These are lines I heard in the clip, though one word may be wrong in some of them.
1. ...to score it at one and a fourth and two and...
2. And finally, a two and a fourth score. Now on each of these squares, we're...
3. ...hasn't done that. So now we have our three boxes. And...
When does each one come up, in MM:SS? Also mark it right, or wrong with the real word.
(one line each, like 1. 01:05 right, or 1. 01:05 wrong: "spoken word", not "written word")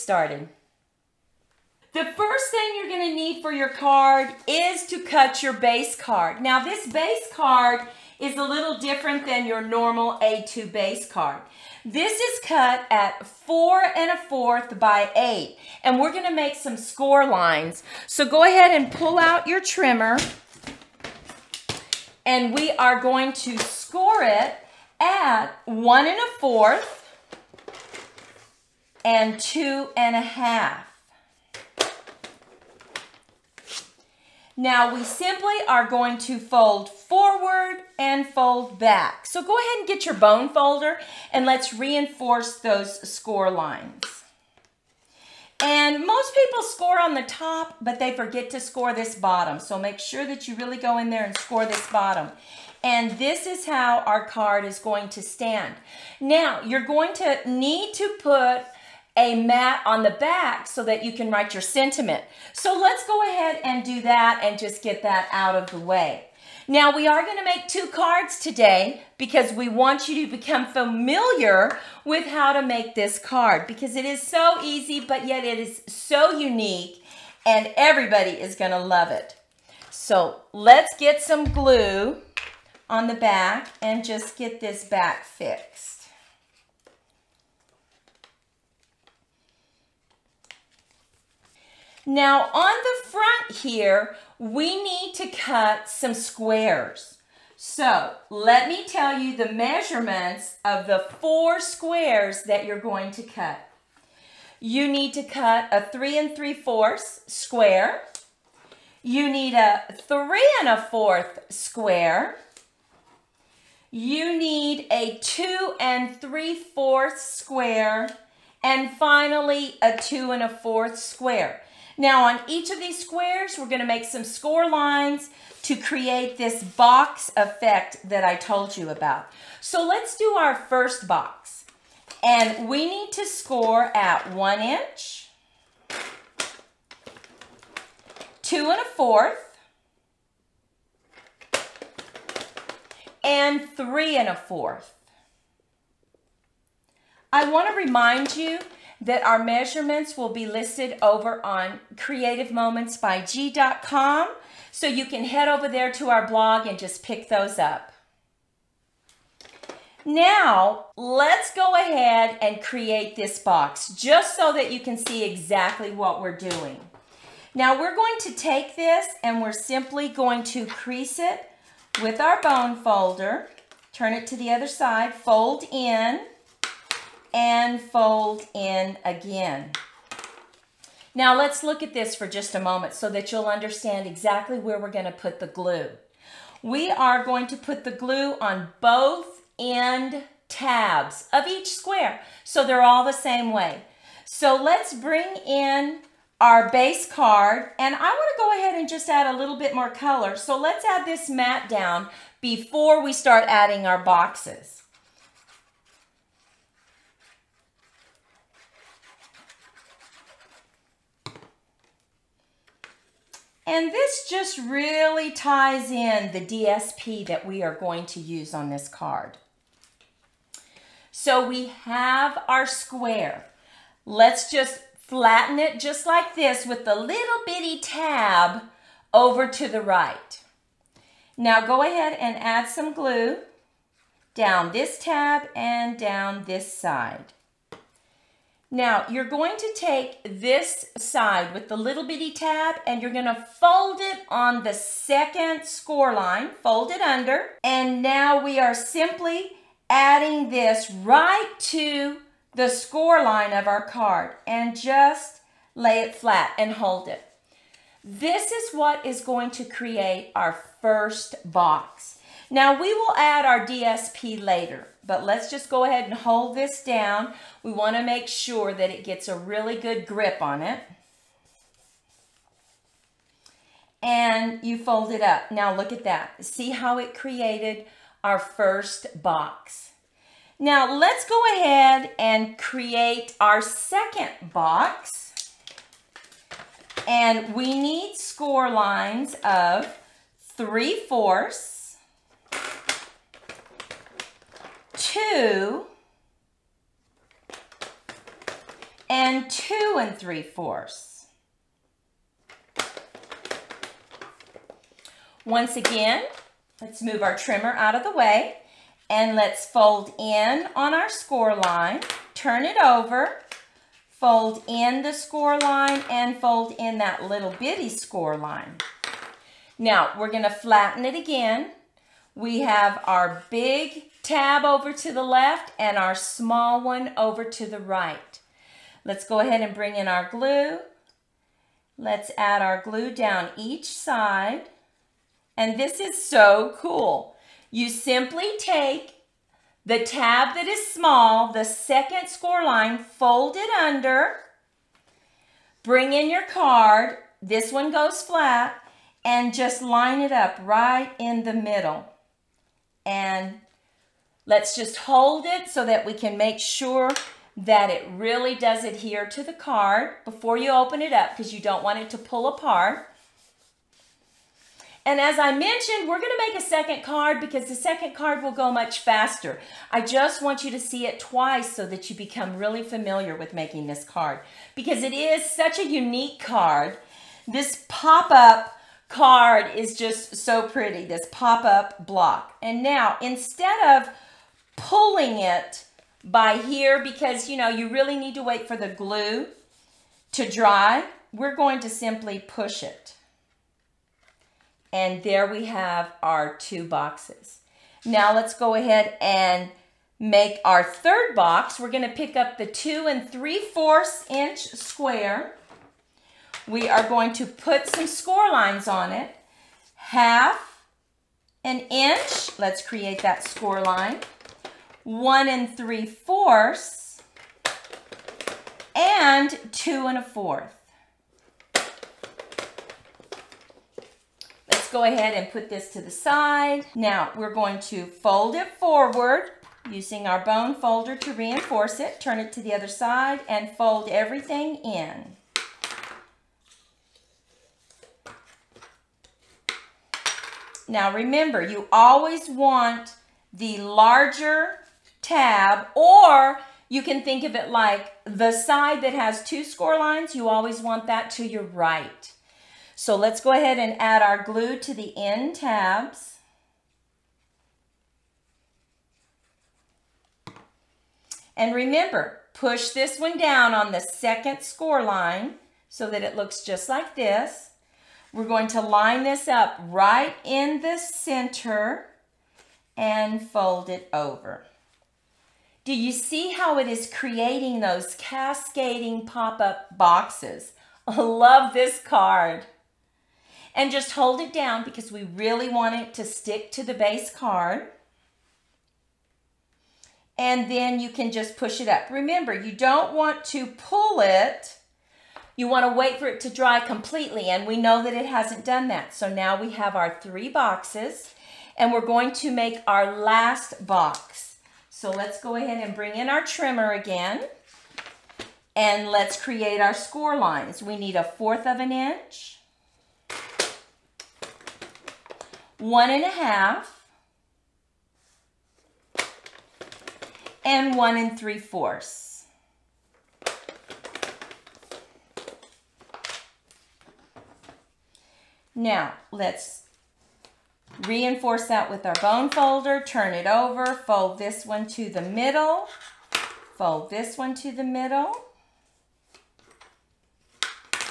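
1. 00:23 right
2. 01:58 wrong: "square", not "score"
3. 08:18 right.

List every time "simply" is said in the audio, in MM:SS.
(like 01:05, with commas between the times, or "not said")
00:35, 02:49, 04:08, 05:37, 06:31.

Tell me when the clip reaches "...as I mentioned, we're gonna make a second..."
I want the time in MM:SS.
06:05.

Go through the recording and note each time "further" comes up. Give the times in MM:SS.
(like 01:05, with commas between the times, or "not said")
not said.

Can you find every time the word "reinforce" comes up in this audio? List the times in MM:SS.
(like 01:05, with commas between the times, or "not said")
00:41, 07:11, 08:51.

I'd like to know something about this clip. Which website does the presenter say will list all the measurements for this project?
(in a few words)
creativemomentsbyg.com.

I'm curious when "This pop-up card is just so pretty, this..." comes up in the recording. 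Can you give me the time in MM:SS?
06:17.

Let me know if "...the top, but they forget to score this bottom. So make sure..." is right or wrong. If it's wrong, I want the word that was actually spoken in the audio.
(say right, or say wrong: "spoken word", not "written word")
right.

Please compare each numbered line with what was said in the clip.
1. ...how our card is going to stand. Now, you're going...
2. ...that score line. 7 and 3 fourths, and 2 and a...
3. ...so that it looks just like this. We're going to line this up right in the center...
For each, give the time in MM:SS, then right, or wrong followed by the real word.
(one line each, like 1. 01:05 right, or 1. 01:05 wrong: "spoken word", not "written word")
1. 00:53 right
2. 06:53 wrong: "1", not "7"
3. 07:45 right.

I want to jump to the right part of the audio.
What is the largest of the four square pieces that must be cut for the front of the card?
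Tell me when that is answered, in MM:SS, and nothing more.
01:45.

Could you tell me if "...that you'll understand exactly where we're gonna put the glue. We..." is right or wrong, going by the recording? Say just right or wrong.
right.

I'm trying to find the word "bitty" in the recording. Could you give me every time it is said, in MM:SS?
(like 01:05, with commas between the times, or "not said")
03:47, 04:02, 05:17.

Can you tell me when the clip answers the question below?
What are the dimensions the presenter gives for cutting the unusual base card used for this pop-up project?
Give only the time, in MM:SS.
00:13.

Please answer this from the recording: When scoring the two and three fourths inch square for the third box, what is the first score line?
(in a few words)
half an inch.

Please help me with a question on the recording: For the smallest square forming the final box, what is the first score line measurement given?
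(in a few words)
1/4 inch.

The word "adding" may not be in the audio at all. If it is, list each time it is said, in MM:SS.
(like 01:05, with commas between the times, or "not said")
03:23, 04:09.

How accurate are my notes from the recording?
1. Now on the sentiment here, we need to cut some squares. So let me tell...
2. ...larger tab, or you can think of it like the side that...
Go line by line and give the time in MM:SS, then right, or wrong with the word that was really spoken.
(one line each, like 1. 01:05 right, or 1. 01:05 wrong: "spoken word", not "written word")
1. 01:32 wrong: "front", not "sentiment"
2. 07:23 right.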